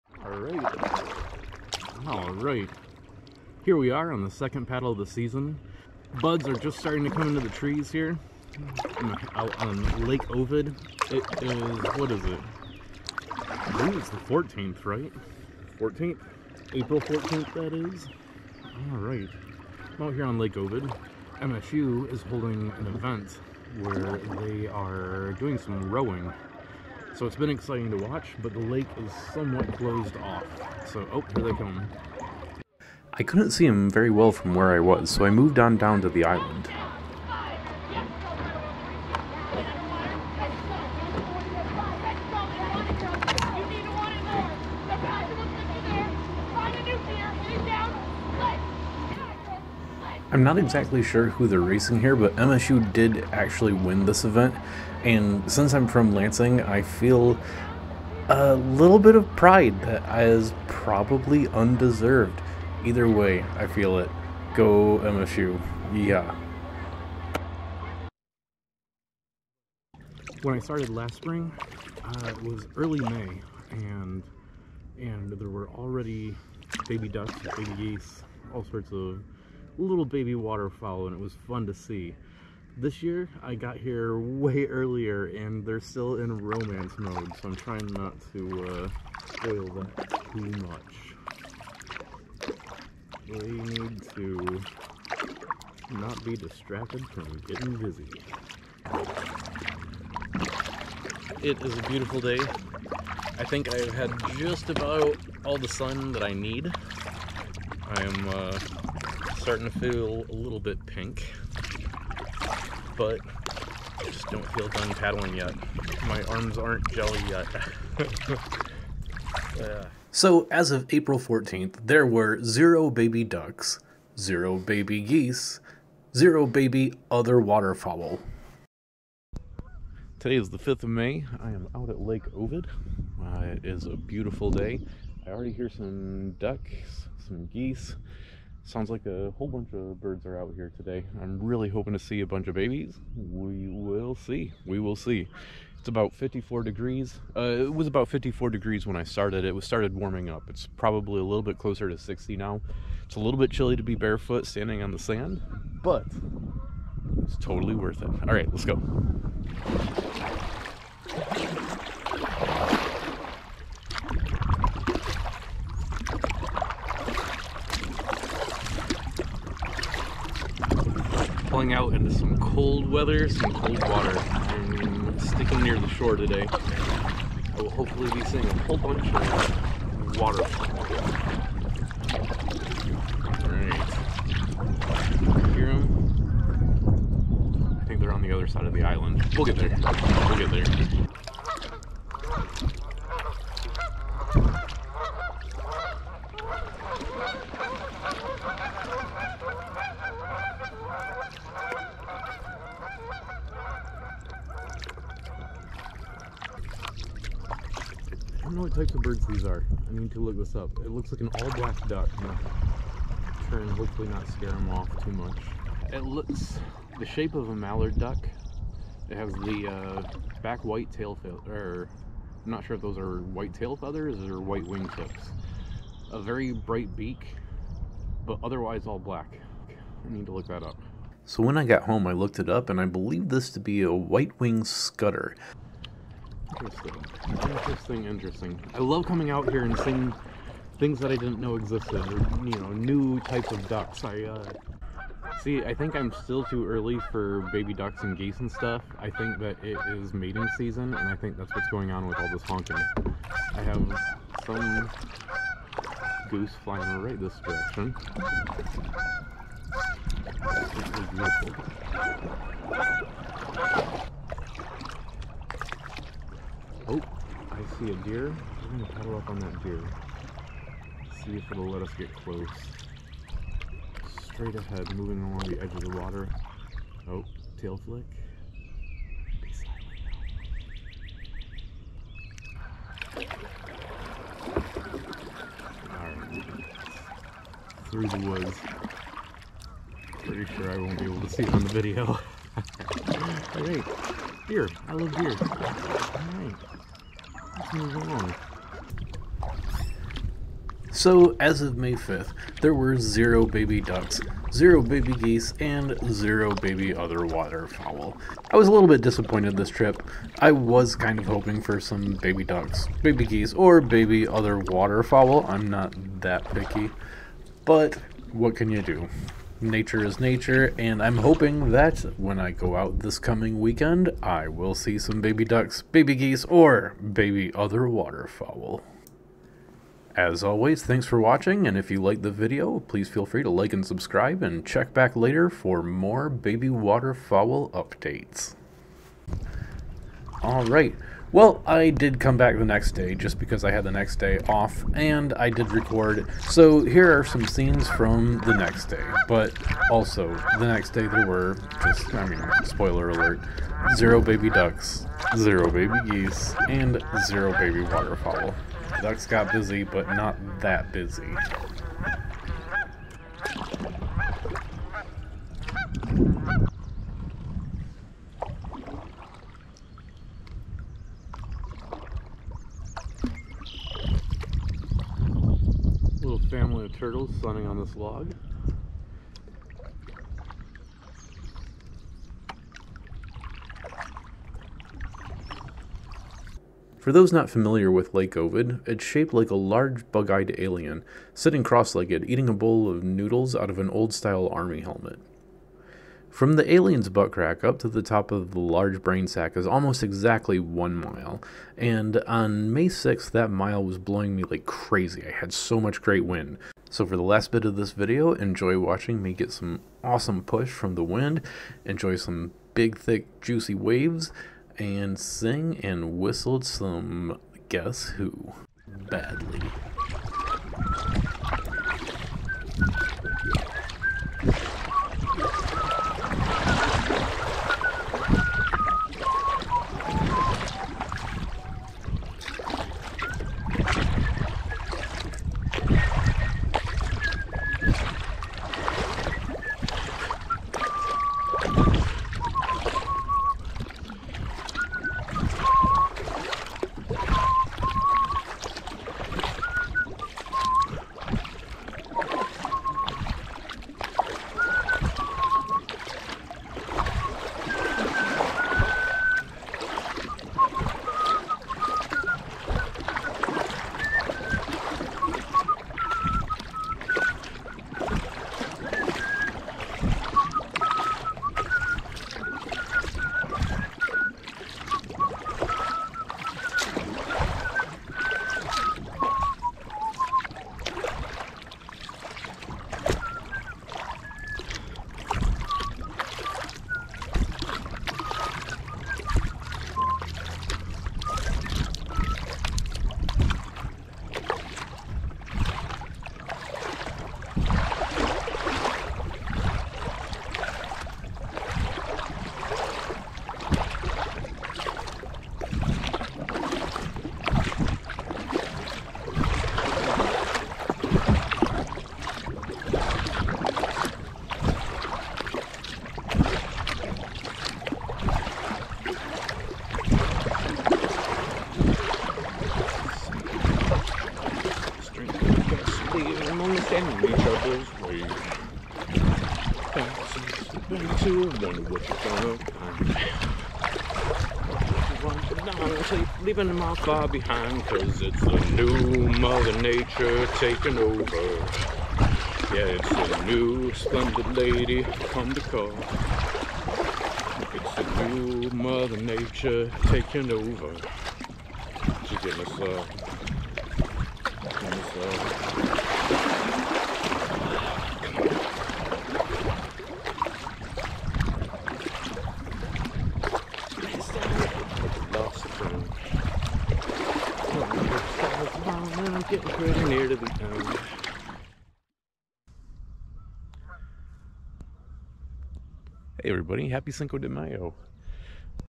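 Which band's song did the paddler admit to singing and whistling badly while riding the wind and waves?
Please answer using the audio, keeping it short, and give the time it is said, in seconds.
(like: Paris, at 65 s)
Guess Who, at 417 s.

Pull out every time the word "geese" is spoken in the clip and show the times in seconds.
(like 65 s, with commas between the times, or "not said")
77 s, 125 s, 137 s, 248 s, 305 s, 313 s, 326 s, 356 s.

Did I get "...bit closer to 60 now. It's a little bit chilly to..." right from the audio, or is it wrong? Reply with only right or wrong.
right.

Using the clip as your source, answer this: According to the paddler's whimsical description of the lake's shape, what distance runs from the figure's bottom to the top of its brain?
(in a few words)
one mile.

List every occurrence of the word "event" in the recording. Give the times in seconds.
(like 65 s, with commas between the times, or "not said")
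22 s, 54 s.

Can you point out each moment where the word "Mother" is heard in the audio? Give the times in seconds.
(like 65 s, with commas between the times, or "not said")
539 s, 548 s.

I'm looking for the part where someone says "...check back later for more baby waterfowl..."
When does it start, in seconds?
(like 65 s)
334 s.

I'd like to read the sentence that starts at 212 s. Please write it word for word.
i try and hopefully not scare them off too much.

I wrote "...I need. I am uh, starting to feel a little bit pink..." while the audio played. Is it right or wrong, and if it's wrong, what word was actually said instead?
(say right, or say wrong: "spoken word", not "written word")
right.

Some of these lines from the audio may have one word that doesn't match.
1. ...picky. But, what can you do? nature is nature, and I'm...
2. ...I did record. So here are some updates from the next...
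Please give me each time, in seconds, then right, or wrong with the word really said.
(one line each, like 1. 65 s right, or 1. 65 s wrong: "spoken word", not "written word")
1. 316 s right
2. 345 s wrong: "scenes", not "updates".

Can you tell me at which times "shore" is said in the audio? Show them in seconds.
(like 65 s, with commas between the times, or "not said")
175 s.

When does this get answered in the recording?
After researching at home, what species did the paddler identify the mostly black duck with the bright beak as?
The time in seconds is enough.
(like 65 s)
233 s.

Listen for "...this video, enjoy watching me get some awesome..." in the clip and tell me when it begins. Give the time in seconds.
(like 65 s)
407 s.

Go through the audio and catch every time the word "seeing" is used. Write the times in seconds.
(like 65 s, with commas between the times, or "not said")
178 s, 239 s.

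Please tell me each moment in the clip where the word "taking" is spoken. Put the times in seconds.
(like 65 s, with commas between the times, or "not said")
540 s, 550 s.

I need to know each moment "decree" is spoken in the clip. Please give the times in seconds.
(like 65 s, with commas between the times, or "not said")
not said.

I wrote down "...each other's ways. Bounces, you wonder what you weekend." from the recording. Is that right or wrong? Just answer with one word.
wrong.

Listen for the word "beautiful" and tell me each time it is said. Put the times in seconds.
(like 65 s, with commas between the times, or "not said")
101 s, 133 s.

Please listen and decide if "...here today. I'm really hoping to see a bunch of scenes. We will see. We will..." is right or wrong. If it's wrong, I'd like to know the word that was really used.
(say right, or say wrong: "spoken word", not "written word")
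wrong: "babies", not "scenes".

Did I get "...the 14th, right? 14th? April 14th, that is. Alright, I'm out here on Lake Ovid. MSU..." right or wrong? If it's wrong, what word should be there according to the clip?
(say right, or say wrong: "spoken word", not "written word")
right.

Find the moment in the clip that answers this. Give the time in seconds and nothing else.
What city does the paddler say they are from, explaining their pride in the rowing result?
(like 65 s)
56 s.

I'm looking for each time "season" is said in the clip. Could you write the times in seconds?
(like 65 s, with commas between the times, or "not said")
5 s, 250 s.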